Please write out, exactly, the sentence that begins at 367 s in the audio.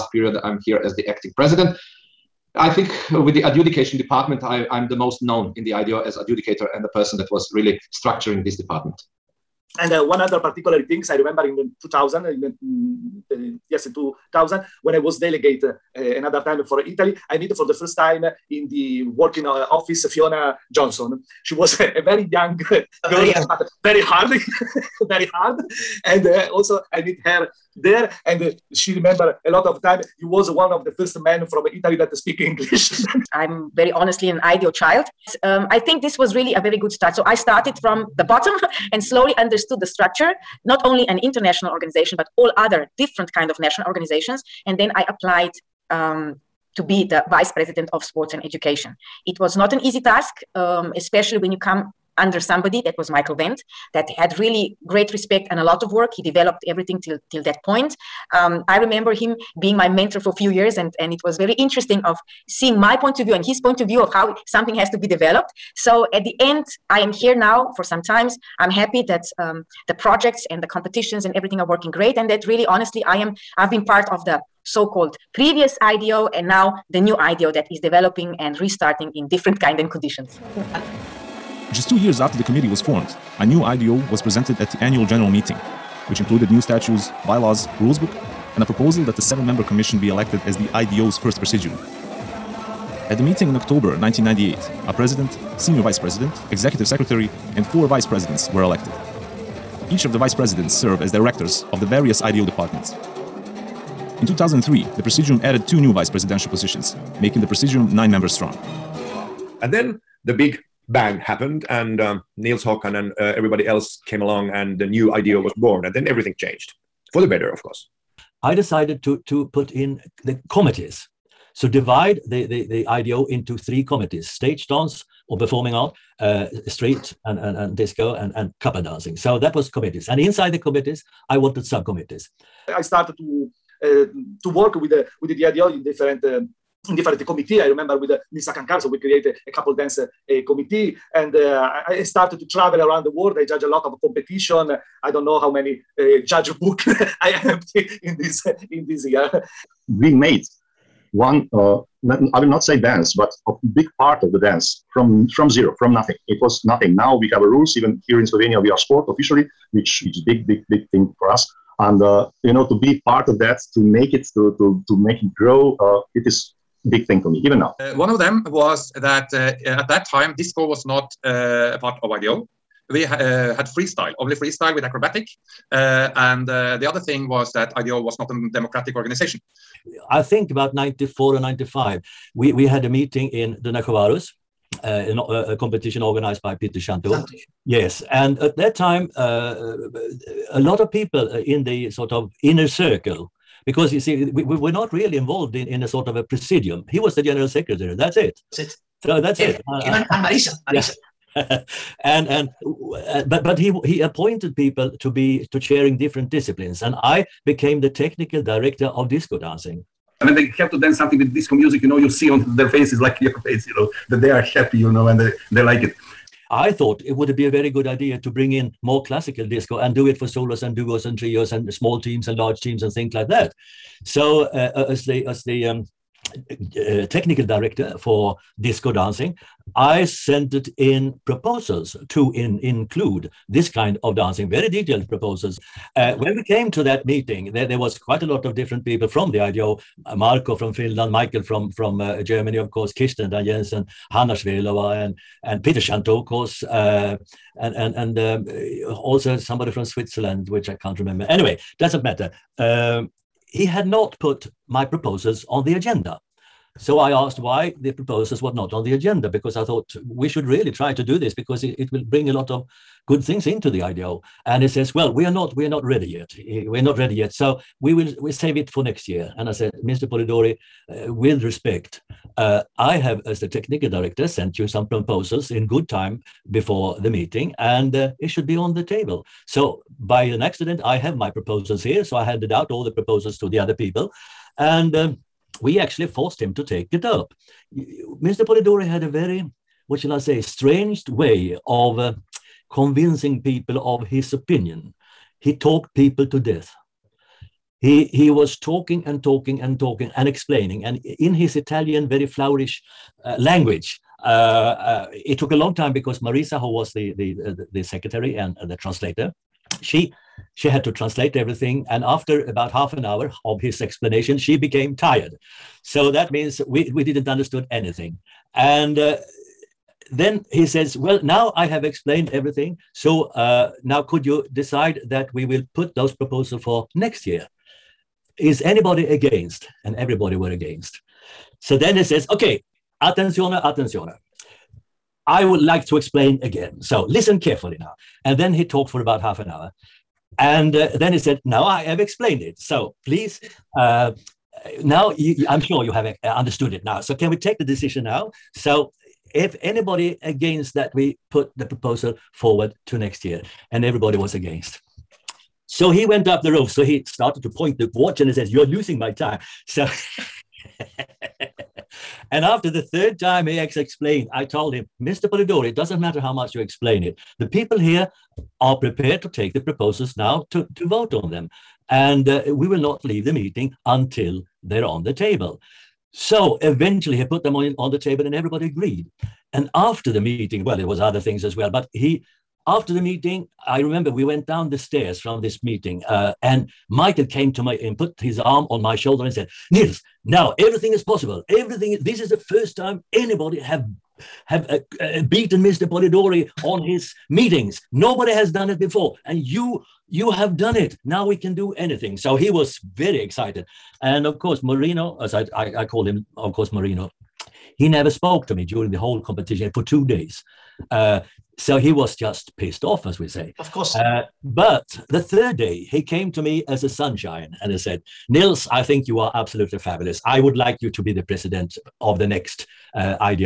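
The people here are prepared to take the proposals now to, to vote on them.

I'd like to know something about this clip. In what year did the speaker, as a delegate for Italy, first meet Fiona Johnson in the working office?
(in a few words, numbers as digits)
2000.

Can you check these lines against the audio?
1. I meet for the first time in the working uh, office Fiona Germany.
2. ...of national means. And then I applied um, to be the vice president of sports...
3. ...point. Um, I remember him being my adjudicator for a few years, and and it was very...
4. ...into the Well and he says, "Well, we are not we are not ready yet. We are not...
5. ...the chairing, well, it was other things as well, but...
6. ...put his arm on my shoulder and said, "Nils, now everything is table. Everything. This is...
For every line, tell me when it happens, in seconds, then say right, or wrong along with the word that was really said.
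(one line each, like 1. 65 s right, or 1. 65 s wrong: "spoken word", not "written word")
1. 17 s wrong: "Johnson", not "Germany"
2. 43 s wrong: "organizations", not "means"
3. 57 s wrong: "mentor", not "adjudicator"
4. 263 s wrong: "IDO", not "Well"
5. 380 s wrong: "meeting", not "chairing"
6. 387 s wrong: "possible", not "table".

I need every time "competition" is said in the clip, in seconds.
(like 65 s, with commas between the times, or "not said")
70 s, 144 s, 185 s, 409 s.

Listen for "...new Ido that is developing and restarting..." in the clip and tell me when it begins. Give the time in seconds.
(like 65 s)
76 s.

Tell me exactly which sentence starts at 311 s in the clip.
And after about half an hour of his explanation, she became tired.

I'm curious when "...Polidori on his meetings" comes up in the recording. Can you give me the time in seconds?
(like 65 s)
395 s.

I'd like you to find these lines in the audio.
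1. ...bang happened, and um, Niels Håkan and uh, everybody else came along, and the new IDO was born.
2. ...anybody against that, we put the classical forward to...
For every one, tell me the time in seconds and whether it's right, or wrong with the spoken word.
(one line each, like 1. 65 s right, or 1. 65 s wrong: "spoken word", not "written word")
1. 110 s right
2. 349 s wrong: "proposal", not "classical".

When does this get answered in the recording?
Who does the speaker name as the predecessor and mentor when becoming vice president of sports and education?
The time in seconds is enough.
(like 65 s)
53 s.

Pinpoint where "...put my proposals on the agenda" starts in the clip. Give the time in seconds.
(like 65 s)
254 s.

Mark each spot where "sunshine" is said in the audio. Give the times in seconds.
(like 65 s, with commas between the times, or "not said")
416 s.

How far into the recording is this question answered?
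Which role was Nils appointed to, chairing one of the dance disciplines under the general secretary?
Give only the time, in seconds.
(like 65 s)
207 s.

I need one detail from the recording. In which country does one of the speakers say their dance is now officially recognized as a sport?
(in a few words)
Slovenia.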